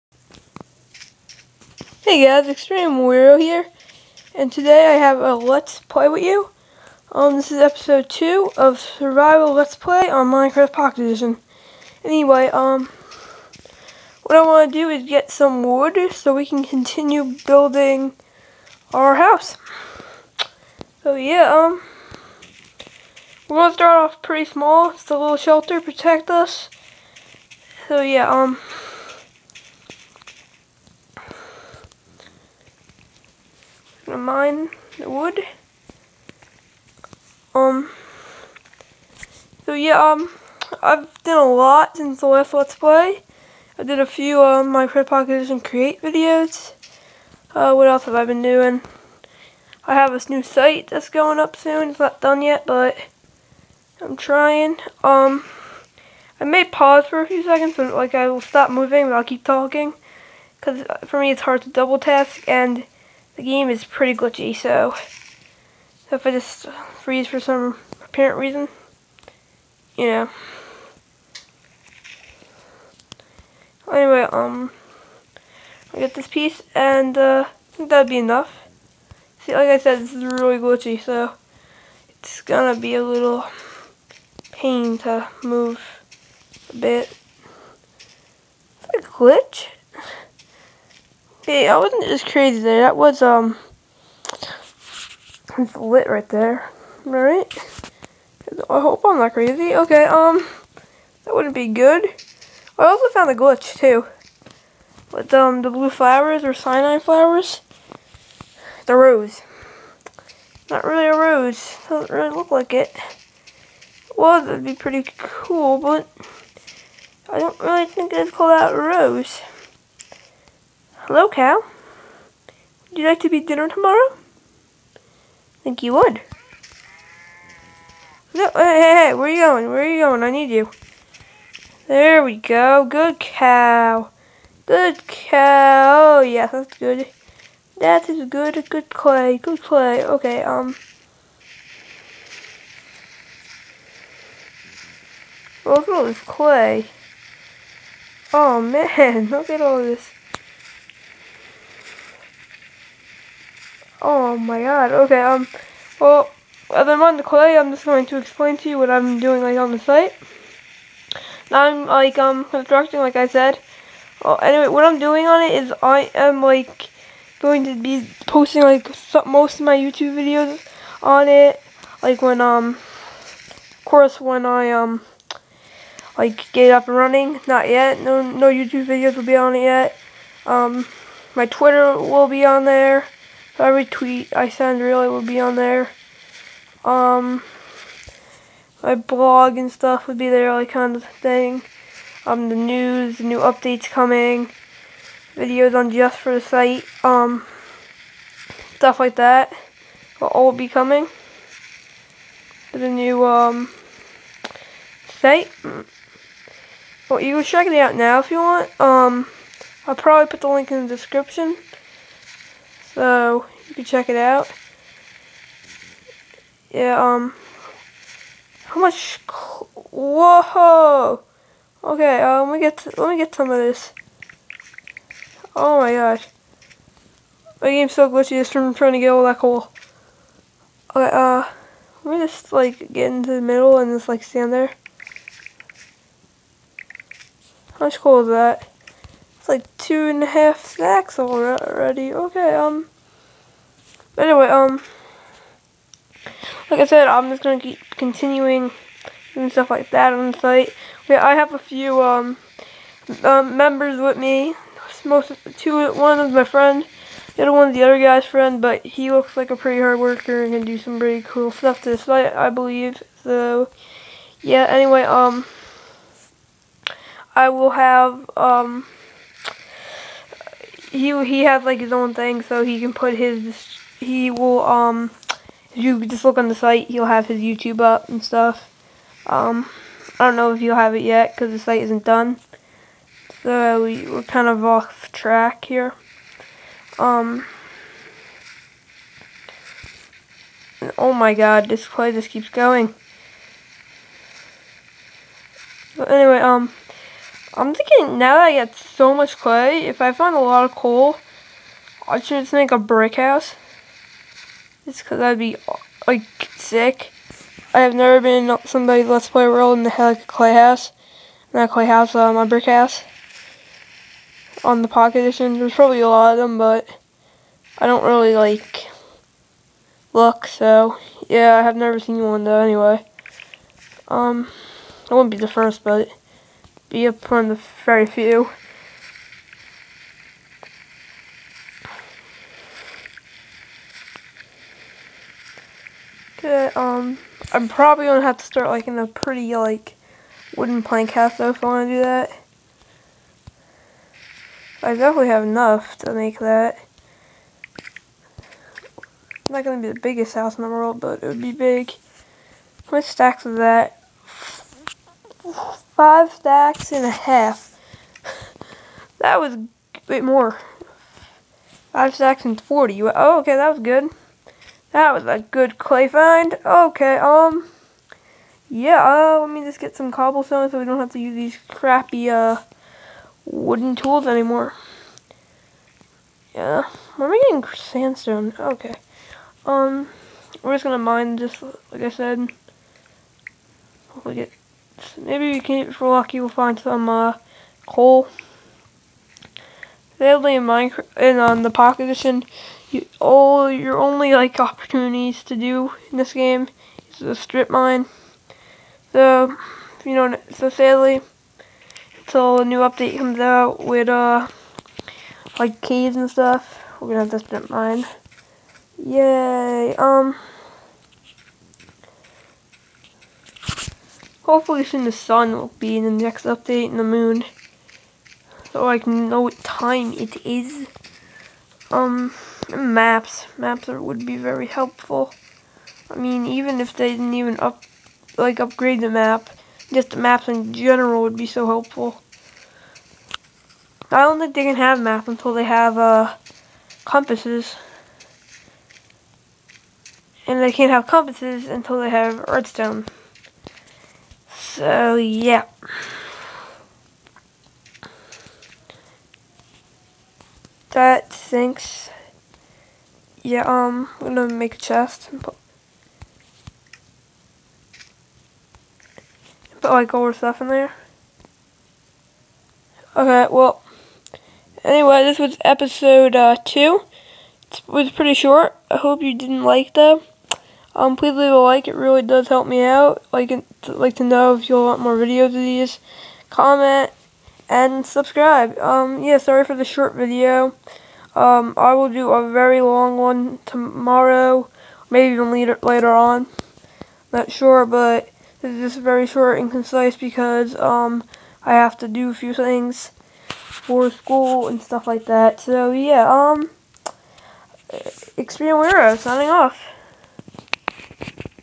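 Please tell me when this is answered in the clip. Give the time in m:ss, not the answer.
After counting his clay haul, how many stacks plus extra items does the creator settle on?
6:01.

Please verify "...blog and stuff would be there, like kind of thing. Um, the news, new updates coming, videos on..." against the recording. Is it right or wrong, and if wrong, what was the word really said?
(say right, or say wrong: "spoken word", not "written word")
right.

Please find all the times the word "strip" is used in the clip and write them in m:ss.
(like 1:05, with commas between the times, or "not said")
6:37, 6:47.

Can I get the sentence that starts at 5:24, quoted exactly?
Um, I wouldn't be the first, but be upon the very few.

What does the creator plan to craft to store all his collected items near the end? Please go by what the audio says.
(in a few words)
chest.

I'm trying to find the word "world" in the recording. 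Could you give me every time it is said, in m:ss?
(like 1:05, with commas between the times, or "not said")
5:09, 5:50.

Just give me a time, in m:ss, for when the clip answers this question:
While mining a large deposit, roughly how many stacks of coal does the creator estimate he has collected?
3:59.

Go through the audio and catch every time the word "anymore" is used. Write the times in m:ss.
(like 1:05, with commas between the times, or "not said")
6:14.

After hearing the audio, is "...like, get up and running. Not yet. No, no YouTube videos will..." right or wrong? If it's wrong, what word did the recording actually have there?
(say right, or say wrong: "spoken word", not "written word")
right.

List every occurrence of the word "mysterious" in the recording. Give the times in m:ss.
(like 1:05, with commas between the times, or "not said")
not said.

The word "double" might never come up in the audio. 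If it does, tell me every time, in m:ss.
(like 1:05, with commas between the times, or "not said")
1:01.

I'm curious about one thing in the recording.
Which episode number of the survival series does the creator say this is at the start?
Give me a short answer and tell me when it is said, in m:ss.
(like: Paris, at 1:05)
2, at 0:07.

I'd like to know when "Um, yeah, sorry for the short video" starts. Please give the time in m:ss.
7:58.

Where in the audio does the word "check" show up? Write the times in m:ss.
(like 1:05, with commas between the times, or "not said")
3:27, 3:33.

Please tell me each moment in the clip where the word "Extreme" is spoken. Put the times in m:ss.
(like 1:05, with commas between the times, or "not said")
0:02, 8:18.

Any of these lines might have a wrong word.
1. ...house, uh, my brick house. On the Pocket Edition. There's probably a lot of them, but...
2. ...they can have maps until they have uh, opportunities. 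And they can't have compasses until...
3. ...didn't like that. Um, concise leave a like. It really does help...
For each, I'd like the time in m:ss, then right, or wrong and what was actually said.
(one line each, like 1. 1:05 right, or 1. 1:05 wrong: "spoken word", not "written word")
1. 5:11 right
2. 7:14 wrong: "compasses", not "opportunities"
3. 7:49 wrong: "please", not "concise".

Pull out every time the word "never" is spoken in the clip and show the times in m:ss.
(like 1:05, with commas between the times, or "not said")
5:07, 5:21.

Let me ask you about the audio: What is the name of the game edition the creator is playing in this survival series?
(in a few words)
Minecraft Pocket Edition.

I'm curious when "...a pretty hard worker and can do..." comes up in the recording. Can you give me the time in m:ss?
4:19.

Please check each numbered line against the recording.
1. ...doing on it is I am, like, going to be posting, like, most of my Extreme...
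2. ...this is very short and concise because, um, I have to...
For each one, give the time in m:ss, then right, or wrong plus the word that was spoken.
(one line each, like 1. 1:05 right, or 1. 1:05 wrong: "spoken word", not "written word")
1. 2:44 wrong: "YouTube", not "Extreme"
2. 8:08 right.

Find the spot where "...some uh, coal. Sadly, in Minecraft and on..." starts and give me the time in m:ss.
6:26.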